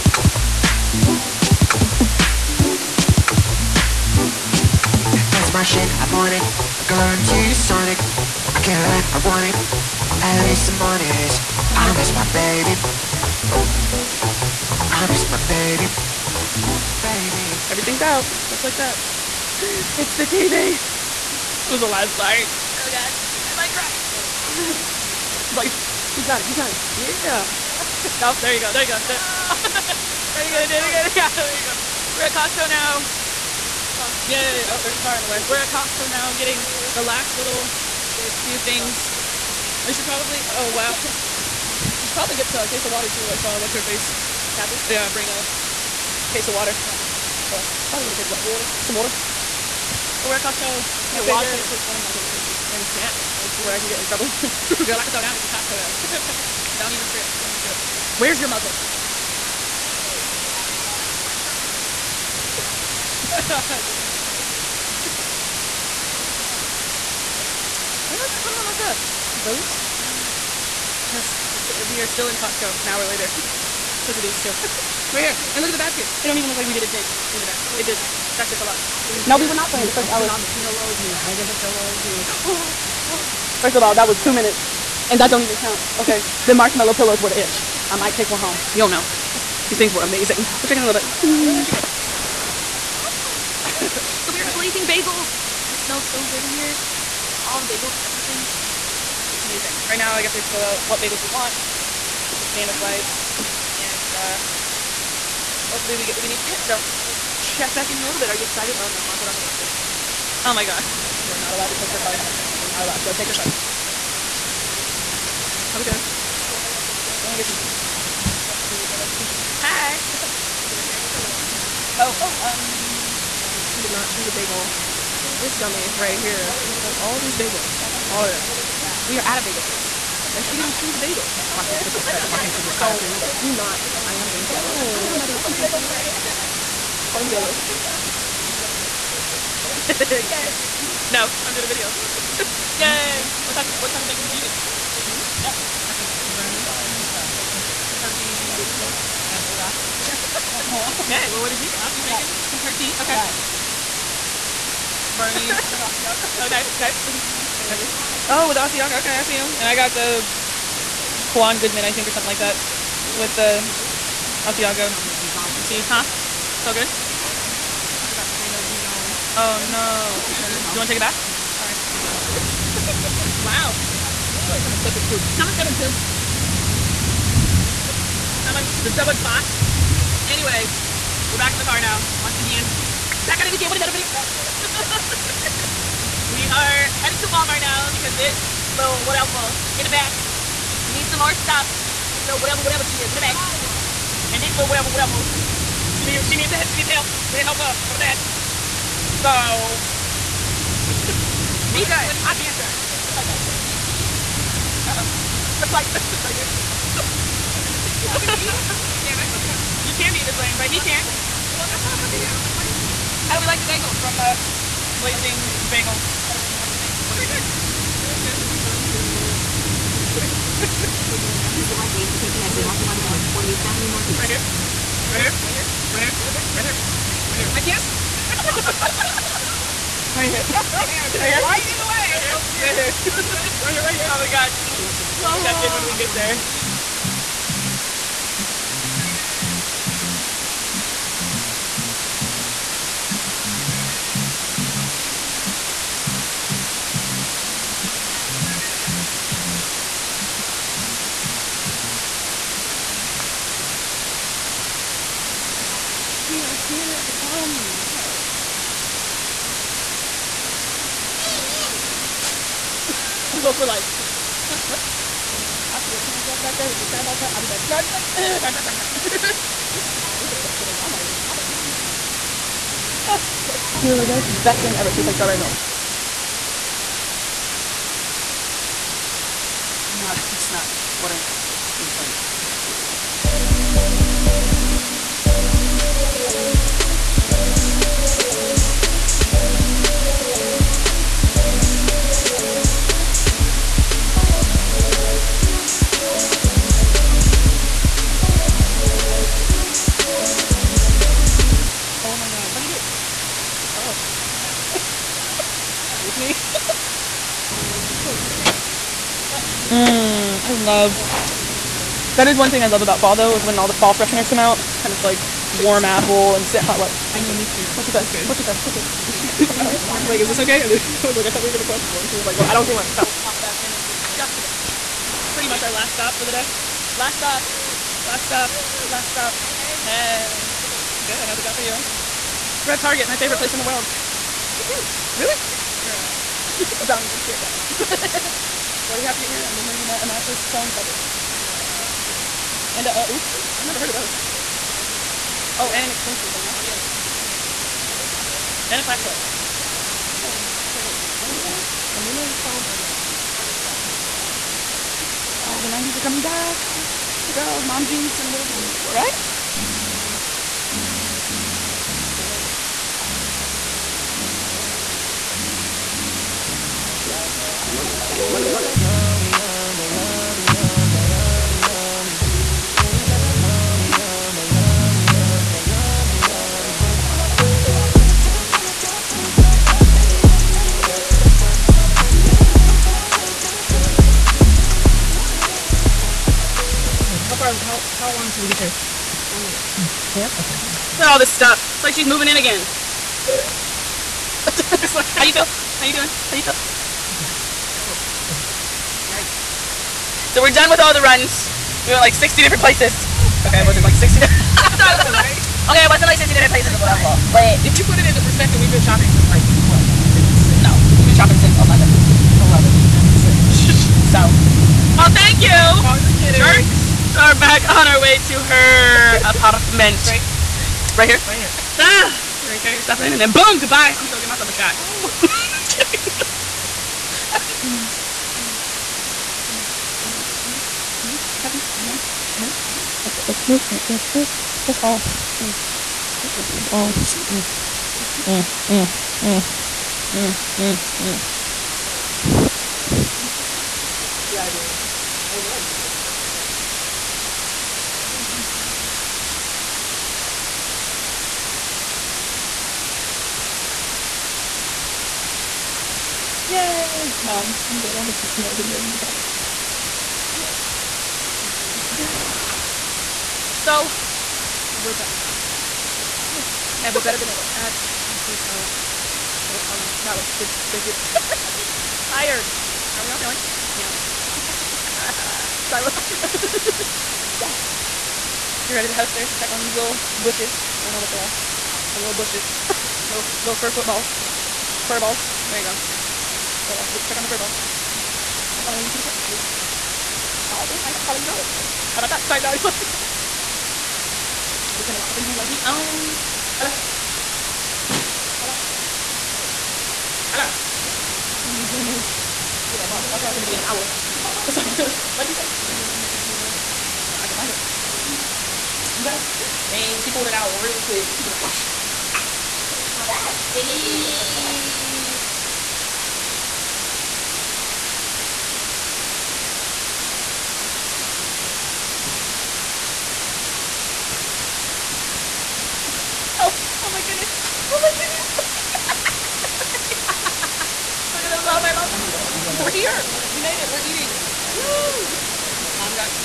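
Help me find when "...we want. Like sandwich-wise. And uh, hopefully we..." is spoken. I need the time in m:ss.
1:41.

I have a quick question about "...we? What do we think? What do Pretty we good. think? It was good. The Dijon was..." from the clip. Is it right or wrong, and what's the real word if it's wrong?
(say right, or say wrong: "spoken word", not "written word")
right.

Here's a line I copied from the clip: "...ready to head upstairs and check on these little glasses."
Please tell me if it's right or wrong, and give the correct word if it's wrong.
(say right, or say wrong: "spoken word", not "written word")
wrong: "bushes", not "glasses".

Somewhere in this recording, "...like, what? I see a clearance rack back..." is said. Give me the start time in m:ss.
4:23.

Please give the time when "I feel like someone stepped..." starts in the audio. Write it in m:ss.
2:54.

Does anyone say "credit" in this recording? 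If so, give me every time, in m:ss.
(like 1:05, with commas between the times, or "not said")
2:12.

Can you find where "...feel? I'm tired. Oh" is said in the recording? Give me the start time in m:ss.
6:36.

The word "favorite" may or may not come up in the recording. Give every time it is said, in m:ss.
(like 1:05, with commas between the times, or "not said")
0:52, 5:33.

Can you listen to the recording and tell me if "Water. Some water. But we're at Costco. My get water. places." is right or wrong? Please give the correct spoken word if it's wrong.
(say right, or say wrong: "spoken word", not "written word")
right.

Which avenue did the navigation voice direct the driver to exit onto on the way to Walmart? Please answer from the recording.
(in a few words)
148th Avenue Northeast.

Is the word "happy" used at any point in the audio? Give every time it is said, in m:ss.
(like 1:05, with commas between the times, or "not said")
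7:11.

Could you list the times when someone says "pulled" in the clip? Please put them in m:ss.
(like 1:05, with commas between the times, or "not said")
8:30.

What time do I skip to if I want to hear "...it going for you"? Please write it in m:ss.
5:31.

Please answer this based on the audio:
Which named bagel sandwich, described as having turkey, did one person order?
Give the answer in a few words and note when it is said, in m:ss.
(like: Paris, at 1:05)
the Bernie, at 2:26.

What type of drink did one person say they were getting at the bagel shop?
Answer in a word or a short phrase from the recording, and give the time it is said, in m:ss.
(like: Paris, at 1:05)
fresh brewed red iced tea, at 1:58.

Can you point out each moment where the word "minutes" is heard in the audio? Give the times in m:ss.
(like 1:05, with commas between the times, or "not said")
1:24, 5:24.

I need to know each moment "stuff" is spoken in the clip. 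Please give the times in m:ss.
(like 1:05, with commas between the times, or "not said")
1:08, 2:29, 3:11, 6:31, 7:02.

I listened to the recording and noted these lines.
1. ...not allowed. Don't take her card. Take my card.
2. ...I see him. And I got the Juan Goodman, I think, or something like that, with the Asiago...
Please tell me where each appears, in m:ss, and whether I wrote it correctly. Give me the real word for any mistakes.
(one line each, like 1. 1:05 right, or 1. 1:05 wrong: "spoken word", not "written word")
1. 1:52 right
2. 2:39 right.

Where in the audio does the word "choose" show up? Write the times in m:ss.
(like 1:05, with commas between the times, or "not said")
2:04, 2:10.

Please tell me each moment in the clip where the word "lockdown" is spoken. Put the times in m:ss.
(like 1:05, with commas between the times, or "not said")
not said.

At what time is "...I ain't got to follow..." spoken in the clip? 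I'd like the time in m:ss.
8:10.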